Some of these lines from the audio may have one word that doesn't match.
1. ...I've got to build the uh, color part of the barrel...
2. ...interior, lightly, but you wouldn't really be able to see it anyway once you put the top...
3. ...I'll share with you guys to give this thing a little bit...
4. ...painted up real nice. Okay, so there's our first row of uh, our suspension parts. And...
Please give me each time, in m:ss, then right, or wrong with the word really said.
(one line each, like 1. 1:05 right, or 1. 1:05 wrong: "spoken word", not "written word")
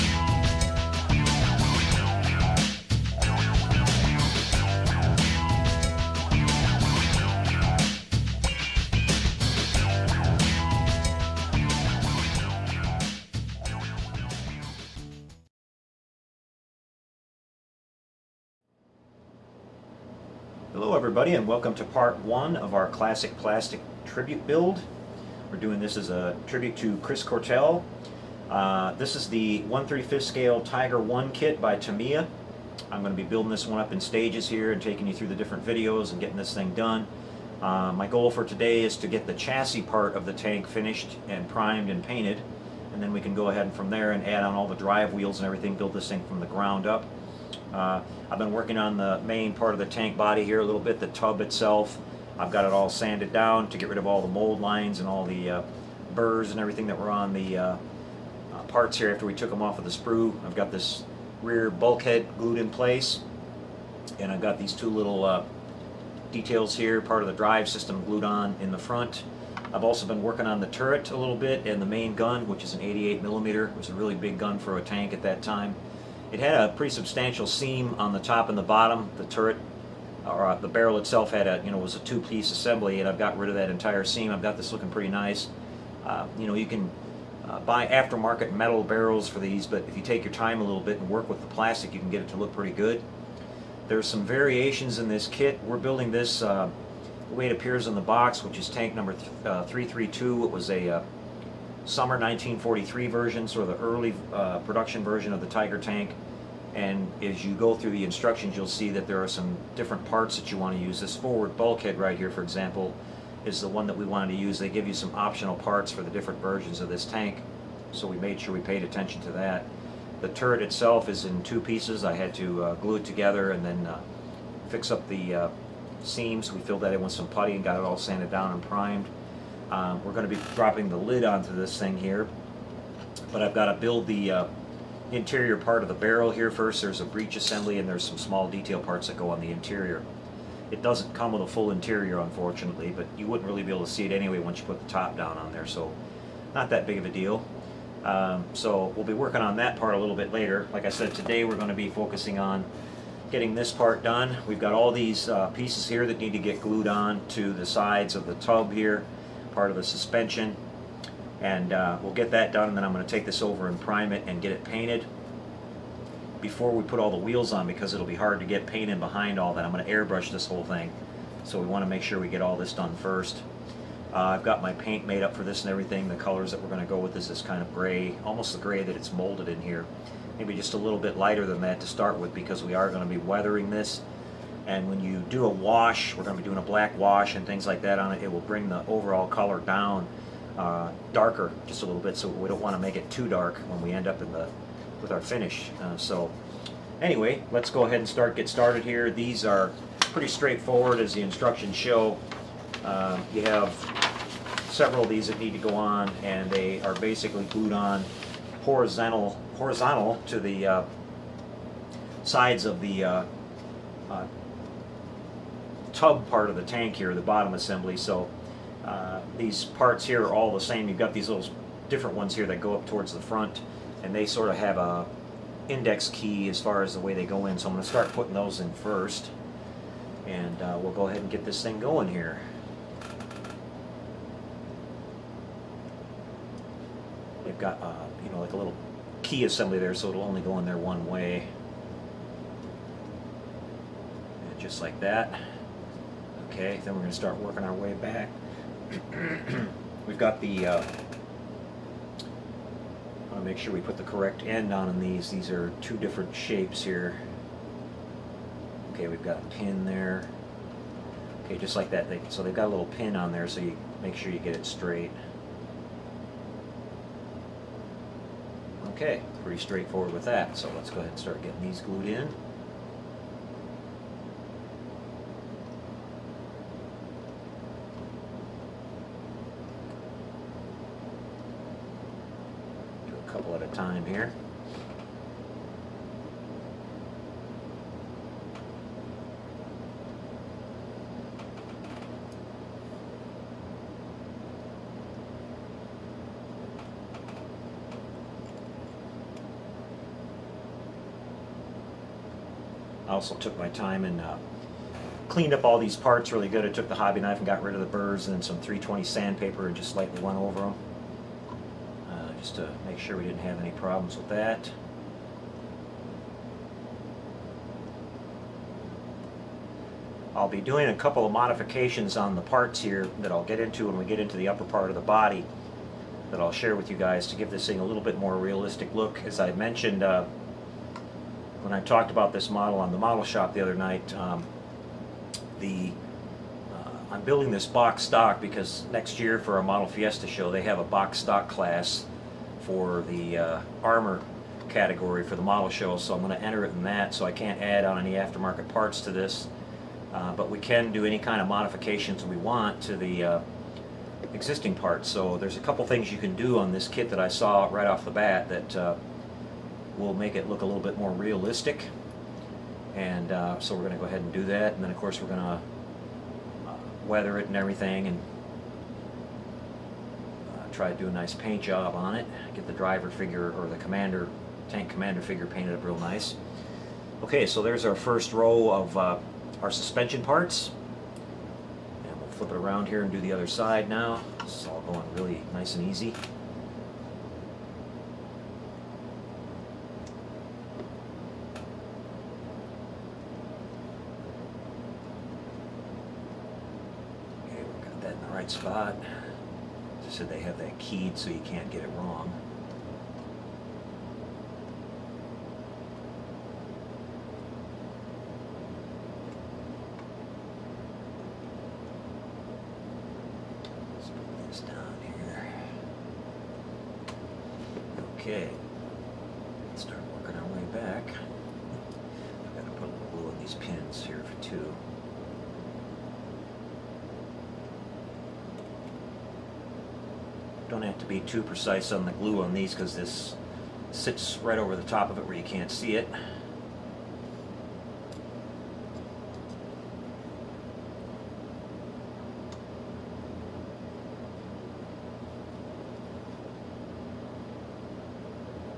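1. 2:13 wrong: "interior", not "color"
2. 2:21 wrong: "unfortunately", not "lightly"
3. 5:26 right
4. 6:15 right.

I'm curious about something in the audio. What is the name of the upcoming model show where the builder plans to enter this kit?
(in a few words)
Model Fiesta.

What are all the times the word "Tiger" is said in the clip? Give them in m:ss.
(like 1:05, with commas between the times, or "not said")
0:30, 1:45.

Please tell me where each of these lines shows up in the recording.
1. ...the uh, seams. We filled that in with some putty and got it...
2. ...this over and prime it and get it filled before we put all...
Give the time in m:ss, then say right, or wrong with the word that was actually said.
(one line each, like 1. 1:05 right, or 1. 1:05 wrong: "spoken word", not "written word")
1. 2:05 right
2. 2:43 wrong: "painted", not "filled".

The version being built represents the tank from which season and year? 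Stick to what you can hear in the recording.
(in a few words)
Summer 1943.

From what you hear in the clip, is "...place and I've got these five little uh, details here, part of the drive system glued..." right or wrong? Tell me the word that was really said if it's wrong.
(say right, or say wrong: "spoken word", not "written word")
wrong: "two", not "five".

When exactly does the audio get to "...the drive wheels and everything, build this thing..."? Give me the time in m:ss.
0:44.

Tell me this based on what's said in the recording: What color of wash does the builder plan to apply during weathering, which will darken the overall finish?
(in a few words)
Black.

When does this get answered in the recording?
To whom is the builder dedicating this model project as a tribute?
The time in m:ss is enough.
0:26.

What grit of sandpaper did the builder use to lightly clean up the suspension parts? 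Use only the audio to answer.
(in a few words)
320.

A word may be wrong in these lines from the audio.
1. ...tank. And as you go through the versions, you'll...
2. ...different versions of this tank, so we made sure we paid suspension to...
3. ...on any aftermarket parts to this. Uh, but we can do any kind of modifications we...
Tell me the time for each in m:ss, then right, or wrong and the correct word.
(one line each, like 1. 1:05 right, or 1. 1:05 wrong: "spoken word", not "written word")
1. 1:45 wrong: "instructions", not "versions"
2. 1:56 wrong: "attention", not "suspension"
3. 5:47 right.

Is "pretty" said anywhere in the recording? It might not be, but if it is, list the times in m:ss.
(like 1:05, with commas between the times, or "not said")
1:16, 1:24, 1:32, 3:20, 4:29.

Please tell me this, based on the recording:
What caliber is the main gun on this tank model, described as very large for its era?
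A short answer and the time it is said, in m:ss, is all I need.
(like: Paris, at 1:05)
88 millimeter, at 1:12.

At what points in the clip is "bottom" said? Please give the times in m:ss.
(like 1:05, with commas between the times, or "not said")
1:18, 3:37.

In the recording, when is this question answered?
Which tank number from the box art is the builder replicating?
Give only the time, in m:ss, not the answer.
1:39.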